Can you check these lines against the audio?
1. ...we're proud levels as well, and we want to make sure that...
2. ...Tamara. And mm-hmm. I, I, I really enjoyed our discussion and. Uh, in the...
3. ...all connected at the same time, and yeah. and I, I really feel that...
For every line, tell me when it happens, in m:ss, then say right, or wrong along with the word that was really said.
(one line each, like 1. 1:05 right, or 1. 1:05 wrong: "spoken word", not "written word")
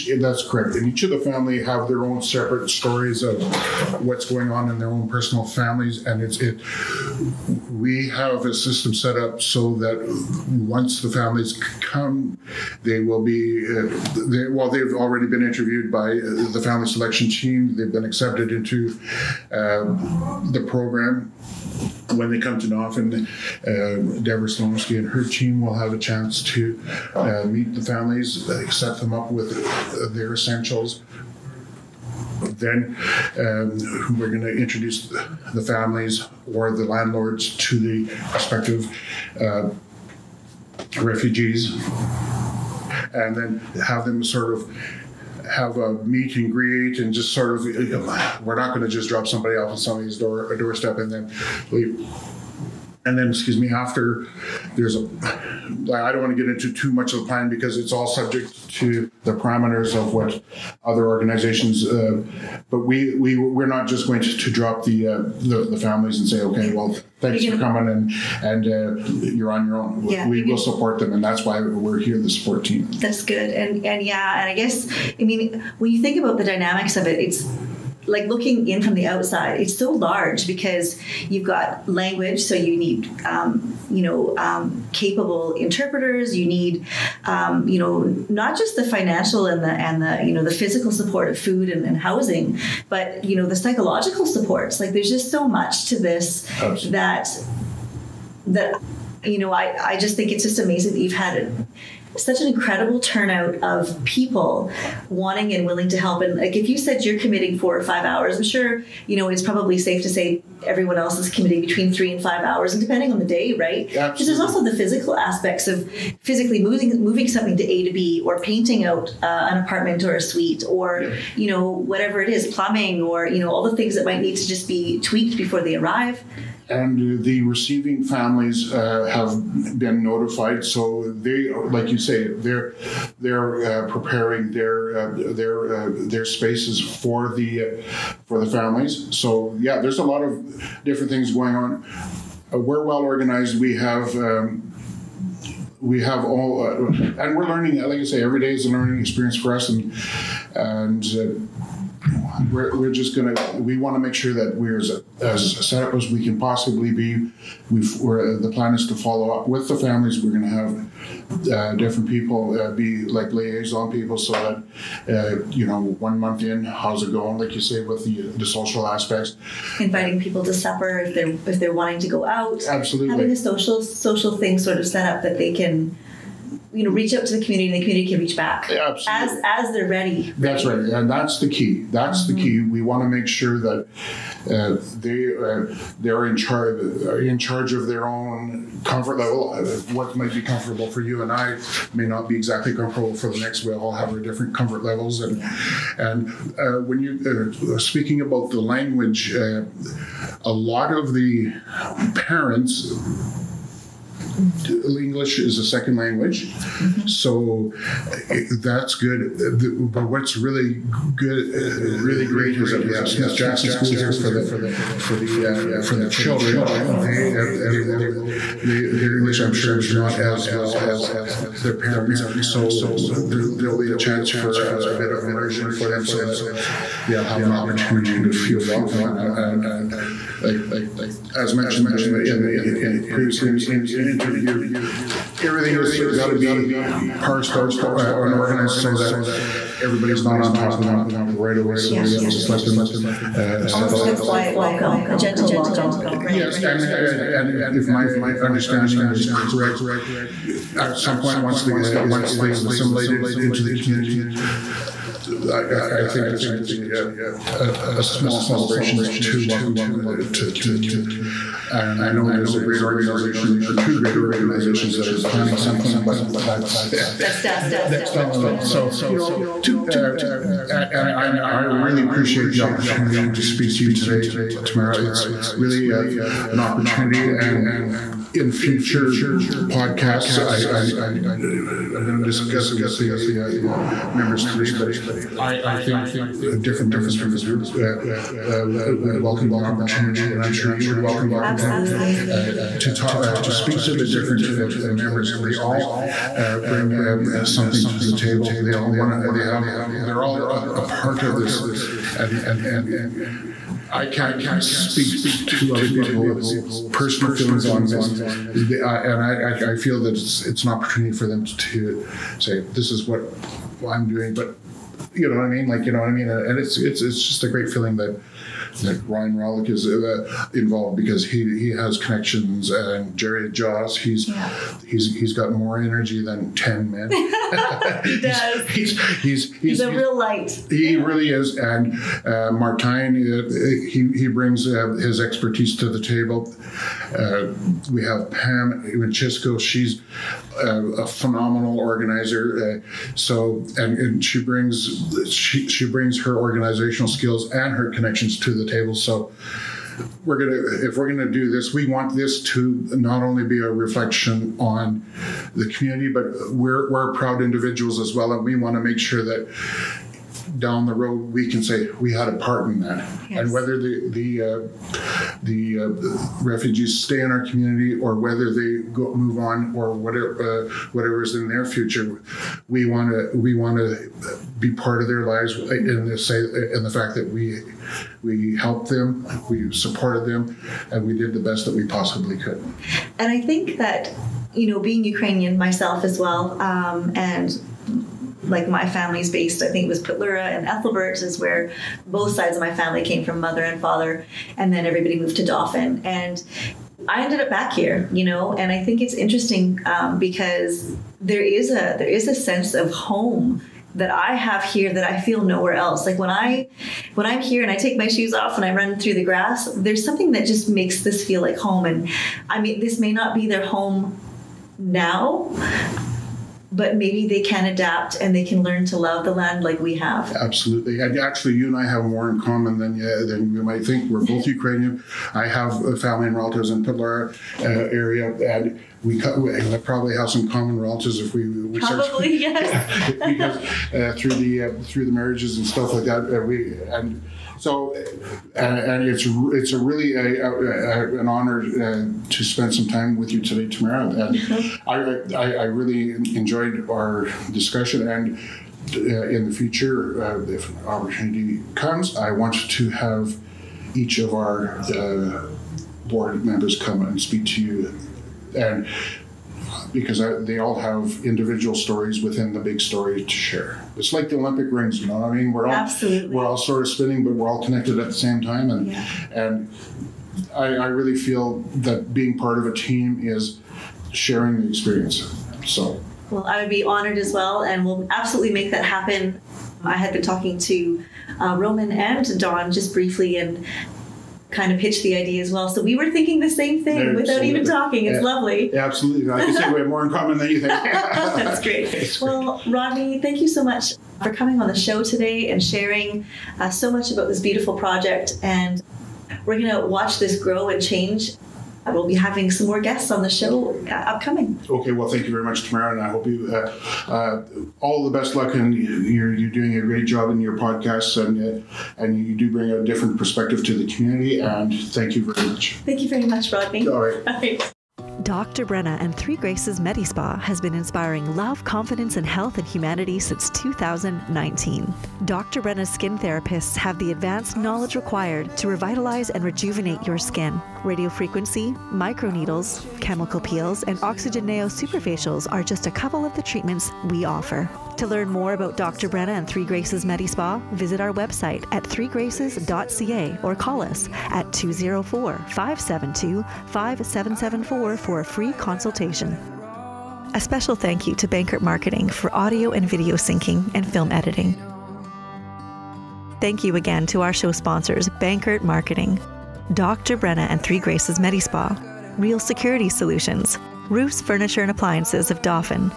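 1. 5:56 wrong: "individuals", not "levels"
2. 7:23 right
3. 7:47 right.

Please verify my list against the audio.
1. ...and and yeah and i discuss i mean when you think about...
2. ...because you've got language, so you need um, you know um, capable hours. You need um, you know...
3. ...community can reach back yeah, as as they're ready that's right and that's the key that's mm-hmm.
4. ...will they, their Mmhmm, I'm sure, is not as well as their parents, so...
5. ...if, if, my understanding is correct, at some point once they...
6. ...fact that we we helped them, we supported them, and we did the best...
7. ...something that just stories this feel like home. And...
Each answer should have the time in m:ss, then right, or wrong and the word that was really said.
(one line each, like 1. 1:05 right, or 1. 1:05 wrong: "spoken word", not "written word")
1. 1:13 wrong: "guess", not "discuss"
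2. 1:20 wrong: "interpreters", not "hours"
3. 2:57 right
4. 3:37 wrong: "English", not "Mmhmm"
5. 4:07 right
6. 6:16 right
7. 6:50 wrong: "makes", not "stories".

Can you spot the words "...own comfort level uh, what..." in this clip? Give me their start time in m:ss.
3:08.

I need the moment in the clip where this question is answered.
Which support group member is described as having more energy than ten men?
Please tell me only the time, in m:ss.
5:23.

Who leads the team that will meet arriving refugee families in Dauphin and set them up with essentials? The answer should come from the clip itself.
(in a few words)
Deborah Slomsky.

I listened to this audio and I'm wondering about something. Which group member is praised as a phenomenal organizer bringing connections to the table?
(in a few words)
Pam Winchesco.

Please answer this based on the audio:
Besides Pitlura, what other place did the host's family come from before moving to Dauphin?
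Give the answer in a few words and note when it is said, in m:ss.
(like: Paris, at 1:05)
Ethelbert, at 6:30.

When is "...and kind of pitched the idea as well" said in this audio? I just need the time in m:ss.
8:03.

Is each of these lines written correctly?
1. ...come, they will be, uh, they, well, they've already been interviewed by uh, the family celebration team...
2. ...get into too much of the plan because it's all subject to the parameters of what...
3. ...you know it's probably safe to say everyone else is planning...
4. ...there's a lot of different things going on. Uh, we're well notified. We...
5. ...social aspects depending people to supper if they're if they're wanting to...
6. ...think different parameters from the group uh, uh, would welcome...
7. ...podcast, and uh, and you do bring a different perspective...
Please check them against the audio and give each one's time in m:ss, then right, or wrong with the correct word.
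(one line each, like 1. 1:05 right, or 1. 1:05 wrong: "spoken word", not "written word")
1. 0:11 wrong: "selection", not "celebration"
2. 0:56 right
3. 1:49 wrong: "committing", not "planning"
4. 2:19 wrong: "organized", not "notified"
5. 2:48 wrong: "inviting", not "depending"
6. 4:45 wrong: "members", not "parameters"
7. 8:30 right.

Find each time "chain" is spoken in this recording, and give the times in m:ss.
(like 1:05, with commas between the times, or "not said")
not said.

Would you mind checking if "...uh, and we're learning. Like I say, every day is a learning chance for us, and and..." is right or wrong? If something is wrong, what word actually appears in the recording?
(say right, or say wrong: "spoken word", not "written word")
wrong: "experience", not "chance".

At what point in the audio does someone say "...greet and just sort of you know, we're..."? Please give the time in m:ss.
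0:46.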